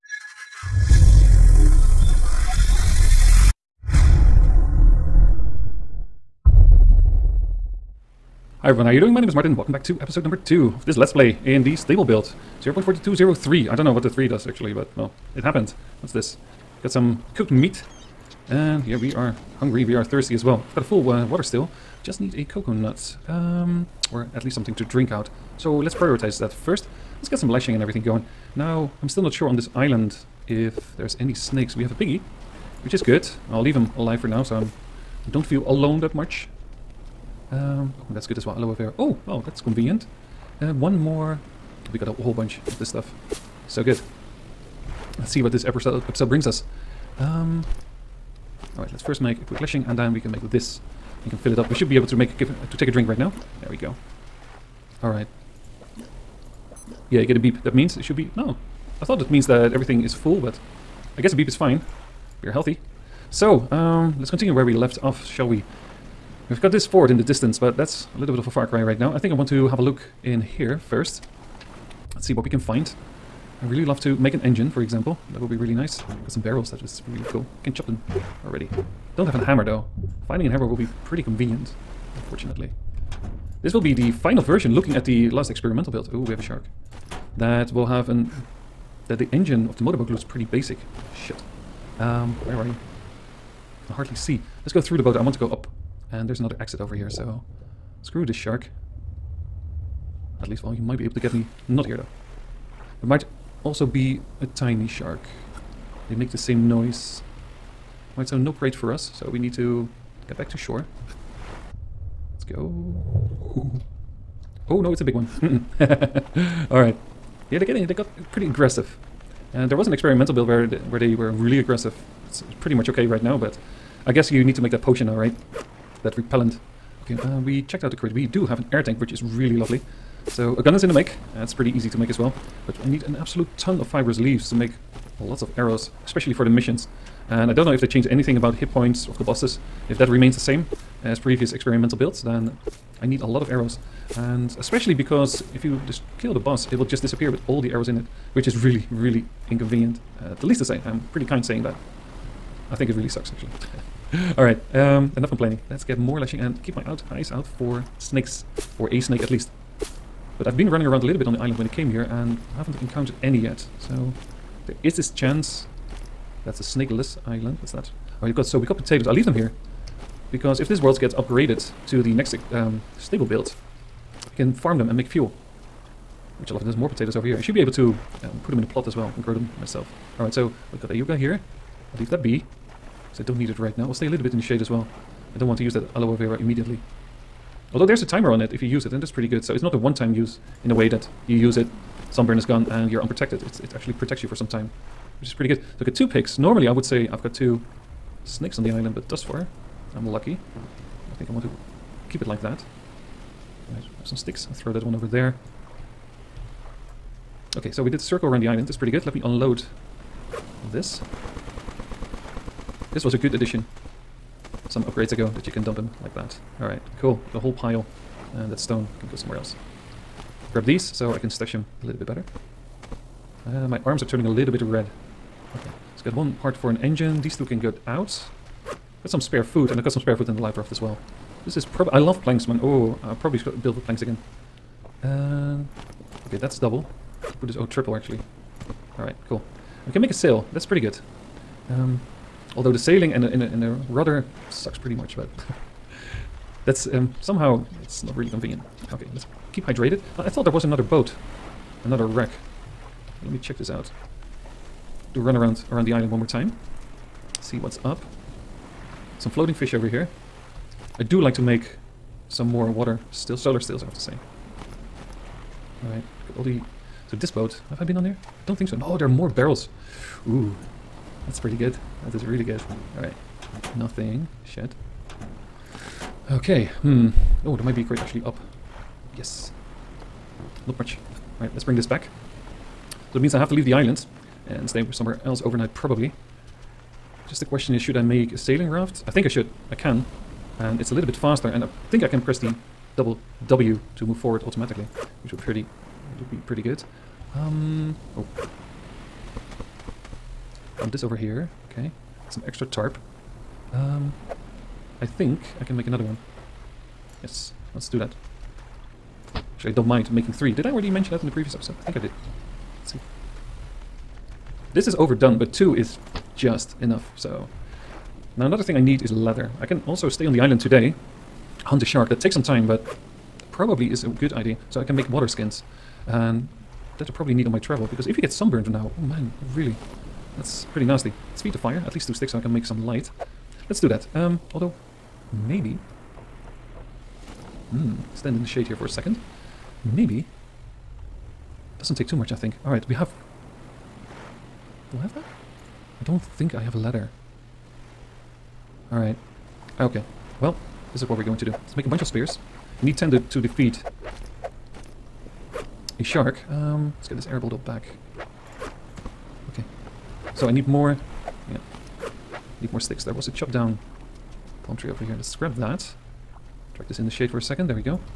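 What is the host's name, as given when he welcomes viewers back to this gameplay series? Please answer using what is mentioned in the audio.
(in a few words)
Martin.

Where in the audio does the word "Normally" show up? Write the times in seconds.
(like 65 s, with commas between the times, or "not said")
196 s.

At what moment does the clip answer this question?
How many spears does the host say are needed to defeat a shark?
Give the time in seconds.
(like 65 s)
352 s.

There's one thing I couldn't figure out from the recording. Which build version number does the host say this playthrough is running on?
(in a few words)
0.4203.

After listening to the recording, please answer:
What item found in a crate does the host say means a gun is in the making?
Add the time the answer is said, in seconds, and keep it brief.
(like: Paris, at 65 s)
Air tank, at 128 s.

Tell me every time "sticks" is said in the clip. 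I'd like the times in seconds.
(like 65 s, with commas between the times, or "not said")
204 s, 332 s, 362 s.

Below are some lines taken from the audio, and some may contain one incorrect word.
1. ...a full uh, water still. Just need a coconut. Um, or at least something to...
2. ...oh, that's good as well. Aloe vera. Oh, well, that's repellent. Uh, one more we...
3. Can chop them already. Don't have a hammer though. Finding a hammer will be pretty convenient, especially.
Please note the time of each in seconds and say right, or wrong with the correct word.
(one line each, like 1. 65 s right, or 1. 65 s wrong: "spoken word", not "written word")
1. 20 s right
2. 37 s wrong: "convenient", not "repellent"
3. 77 s wrong: "unfortunately", not "especially".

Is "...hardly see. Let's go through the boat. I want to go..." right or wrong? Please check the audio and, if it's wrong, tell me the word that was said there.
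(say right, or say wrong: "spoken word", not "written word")
right.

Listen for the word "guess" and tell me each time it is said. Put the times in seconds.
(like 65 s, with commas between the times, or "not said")
61 s, 124 s.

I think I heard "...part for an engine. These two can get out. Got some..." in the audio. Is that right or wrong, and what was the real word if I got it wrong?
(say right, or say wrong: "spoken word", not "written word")
right.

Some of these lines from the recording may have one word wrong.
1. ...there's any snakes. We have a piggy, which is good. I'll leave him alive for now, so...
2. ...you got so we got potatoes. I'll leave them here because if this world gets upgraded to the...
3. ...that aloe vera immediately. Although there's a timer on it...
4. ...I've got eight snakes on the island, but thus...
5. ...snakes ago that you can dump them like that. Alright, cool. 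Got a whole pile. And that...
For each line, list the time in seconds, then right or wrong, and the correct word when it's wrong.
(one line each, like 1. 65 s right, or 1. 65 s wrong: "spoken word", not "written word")
1. 30 s right
2. 168 s right
3. 185 s right
4. 197 s wrong: "two", not "eight"
5. 214 s wrong: "upgrades", not "snakes".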